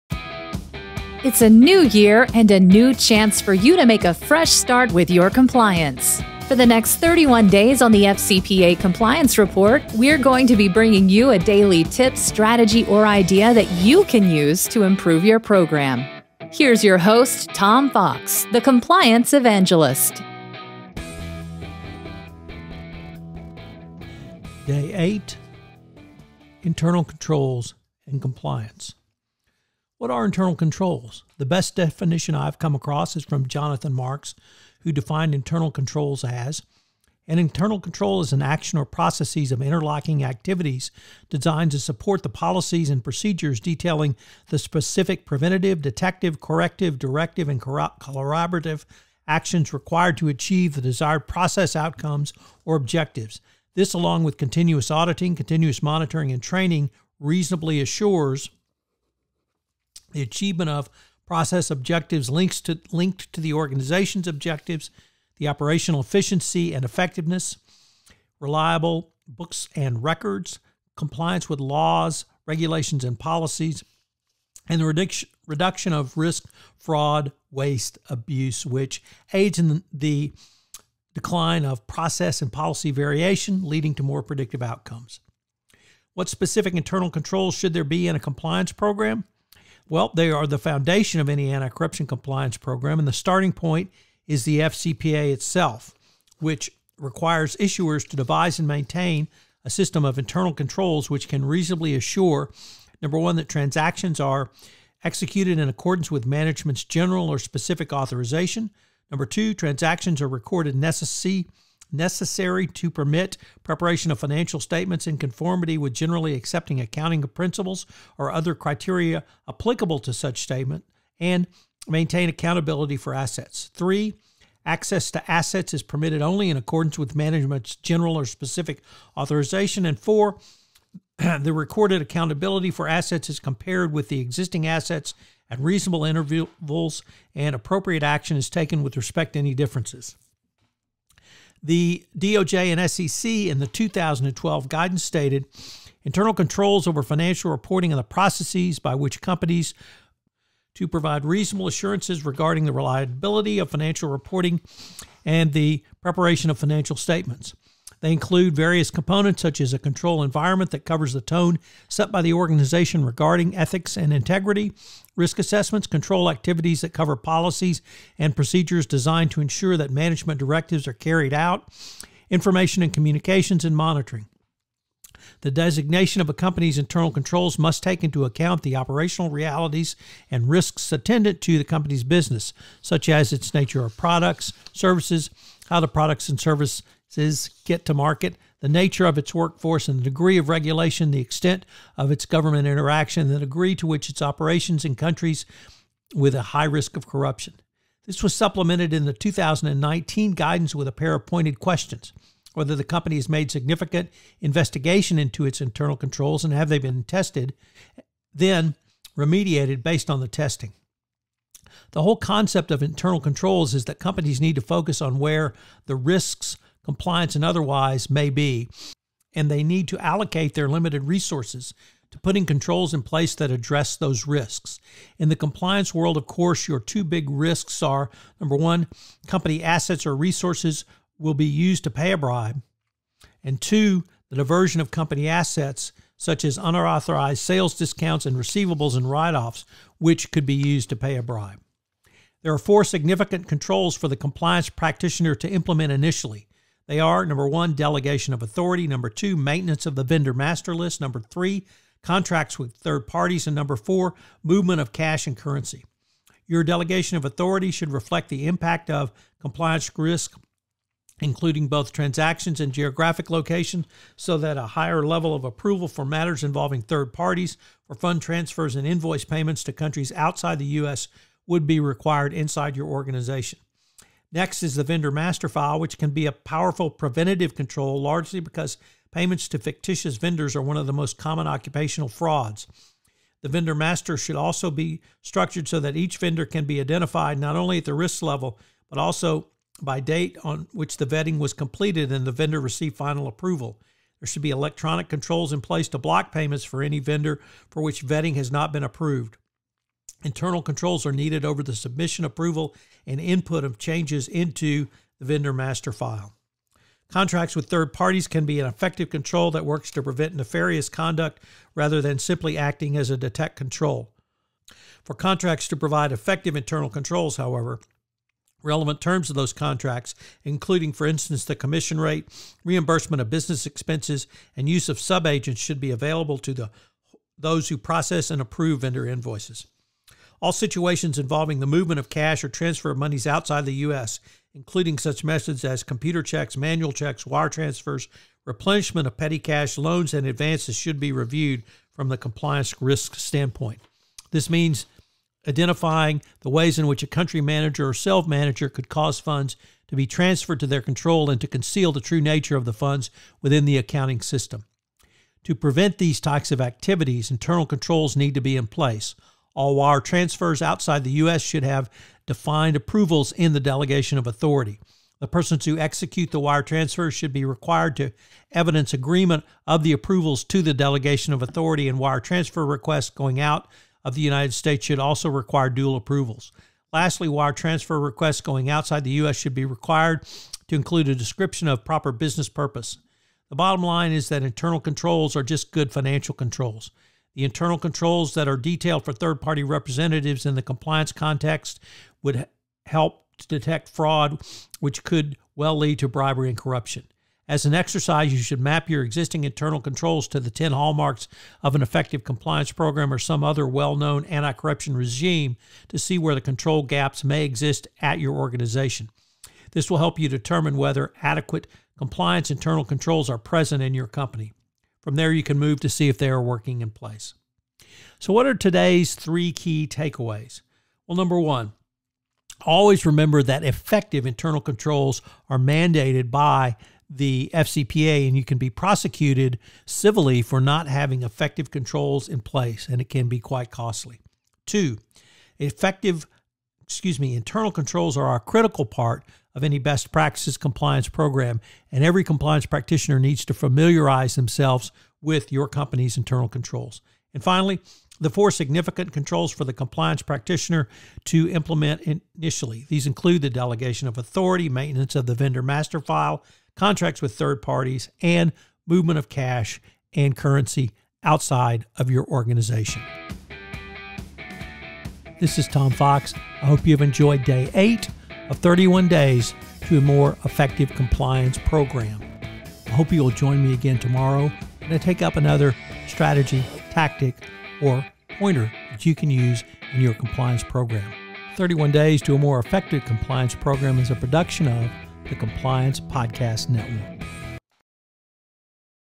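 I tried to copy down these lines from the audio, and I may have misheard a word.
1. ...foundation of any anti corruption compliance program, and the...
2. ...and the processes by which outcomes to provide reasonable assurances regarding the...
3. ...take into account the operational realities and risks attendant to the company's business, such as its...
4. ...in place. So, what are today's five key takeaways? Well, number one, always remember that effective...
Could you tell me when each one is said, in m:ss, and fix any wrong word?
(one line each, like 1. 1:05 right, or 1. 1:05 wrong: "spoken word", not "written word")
1. 1:30 right
2. 2:27 wrong: "companies", not "outcomes"
3. 2:57 right
4. 6:56 wrong: "three", not "five".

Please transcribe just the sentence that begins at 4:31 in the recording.
would be required inside your organization.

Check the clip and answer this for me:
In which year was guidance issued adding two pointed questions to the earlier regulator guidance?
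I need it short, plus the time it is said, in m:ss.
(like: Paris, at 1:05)
2019, at 3:19.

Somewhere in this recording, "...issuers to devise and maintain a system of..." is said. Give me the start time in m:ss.
1:37.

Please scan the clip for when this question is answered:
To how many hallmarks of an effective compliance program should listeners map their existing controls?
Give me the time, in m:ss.
6:40.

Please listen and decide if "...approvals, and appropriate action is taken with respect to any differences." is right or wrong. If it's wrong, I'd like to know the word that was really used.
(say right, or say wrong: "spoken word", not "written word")
wrong: "intervals", not "approvals".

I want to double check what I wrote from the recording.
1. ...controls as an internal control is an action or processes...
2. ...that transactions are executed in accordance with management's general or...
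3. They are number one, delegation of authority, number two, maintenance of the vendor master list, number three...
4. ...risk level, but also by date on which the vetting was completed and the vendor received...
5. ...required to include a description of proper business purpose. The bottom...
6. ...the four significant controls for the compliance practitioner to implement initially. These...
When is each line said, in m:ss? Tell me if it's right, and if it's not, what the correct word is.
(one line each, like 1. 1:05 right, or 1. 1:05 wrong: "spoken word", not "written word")
1. 0:35 right
2. 1:43 right
3. 4:06 right
4. 4:47 right
5. 6:19 right
6. 7:28 right.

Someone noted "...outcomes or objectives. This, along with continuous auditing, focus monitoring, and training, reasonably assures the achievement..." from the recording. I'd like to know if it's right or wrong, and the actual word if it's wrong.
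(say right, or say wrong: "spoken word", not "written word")
wrong: "continuous", not "focus".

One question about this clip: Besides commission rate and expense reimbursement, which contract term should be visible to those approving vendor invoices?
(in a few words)
use of subagents.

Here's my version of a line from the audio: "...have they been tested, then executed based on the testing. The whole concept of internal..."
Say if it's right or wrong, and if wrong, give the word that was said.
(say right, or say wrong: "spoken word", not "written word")
wrong: "remediated", not "executed".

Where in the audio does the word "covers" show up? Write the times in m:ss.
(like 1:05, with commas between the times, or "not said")
2:40, 2:46.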